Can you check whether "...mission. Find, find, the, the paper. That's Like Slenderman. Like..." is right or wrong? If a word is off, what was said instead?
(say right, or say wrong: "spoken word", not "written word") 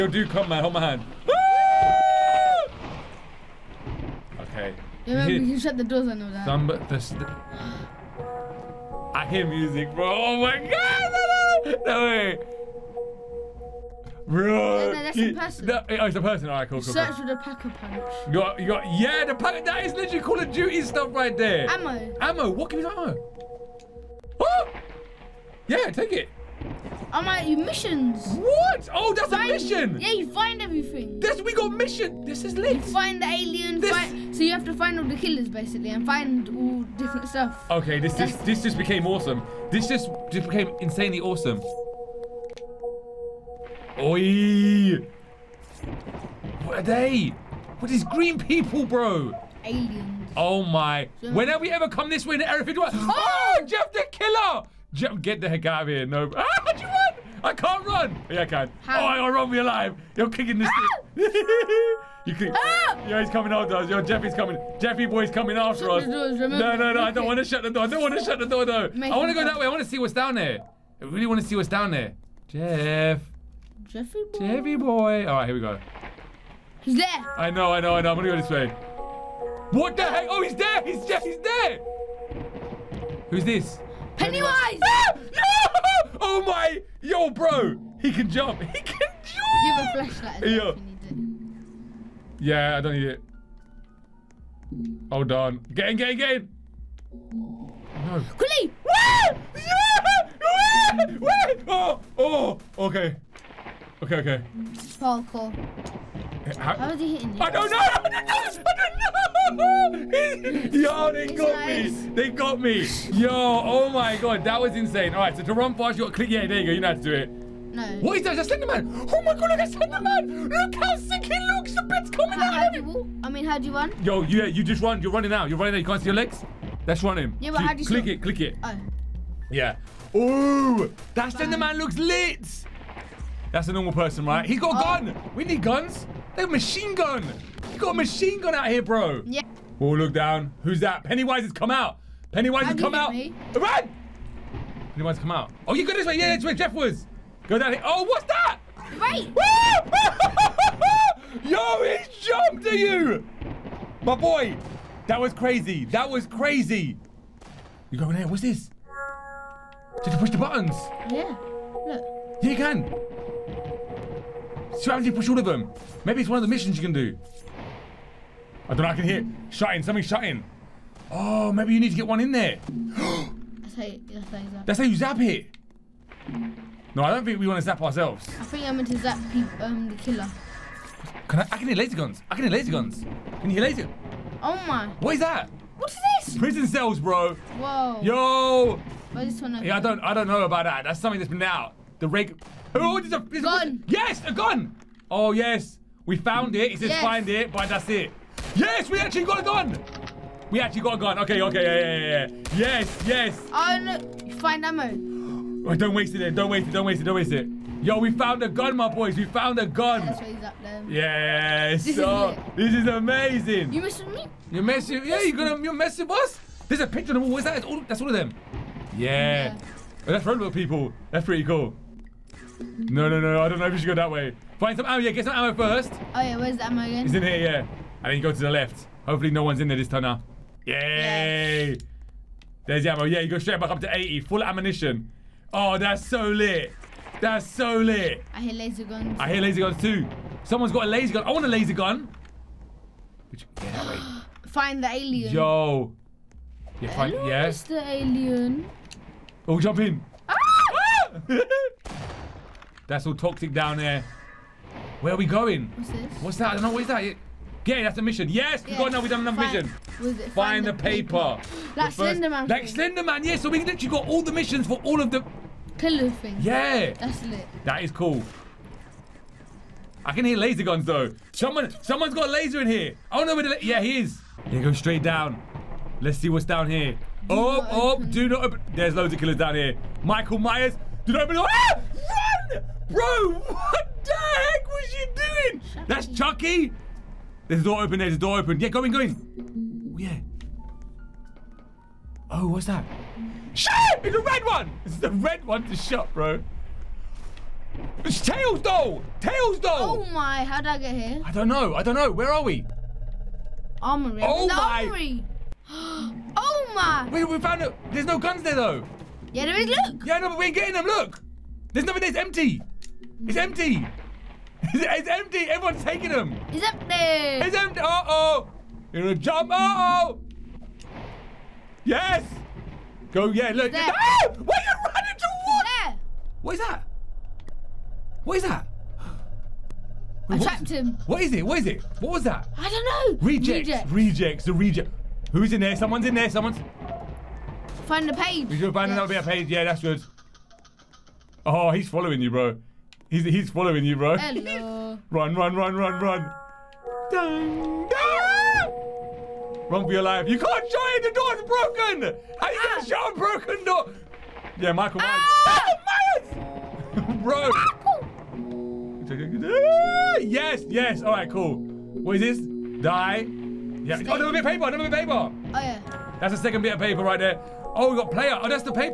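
right.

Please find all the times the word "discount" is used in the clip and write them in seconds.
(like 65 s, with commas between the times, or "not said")
not said.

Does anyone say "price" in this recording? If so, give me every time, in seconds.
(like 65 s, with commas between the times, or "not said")
not said.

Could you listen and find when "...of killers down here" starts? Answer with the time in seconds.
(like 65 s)
279 s.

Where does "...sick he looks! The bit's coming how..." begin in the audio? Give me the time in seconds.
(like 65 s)
120 s.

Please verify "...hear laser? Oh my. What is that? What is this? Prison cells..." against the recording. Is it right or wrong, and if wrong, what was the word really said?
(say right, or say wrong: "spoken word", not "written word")
right.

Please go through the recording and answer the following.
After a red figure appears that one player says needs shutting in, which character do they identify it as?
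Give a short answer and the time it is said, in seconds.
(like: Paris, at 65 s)
Tails doll, at 298 s.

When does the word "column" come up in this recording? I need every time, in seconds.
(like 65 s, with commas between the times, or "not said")
not said.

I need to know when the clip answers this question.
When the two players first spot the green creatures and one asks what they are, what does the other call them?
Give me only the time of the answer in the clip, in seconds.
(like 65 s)
49 s.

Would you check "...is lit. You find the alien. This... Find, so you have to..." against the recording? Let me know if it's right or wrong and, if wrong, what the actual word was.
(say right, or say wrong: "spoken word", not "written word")
right.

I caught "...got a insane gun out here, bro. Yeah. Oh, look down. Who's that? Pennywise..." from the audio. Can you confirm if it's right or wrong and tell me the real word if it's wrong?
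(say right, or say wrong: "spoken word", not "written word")
wrong: "machine", not "insane".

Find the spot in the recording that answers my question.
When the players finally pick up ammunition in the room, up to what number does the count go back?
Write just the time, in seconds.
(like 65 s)
233 s.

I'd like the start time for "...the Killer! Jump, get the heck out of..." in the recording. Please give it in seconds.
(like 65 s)
53 s.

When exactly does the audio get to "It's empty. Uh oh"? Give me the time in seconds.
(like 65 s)
316 s.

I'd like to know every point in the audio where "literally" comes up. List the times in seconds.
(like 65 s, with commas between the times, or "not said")
19 s, 263 s.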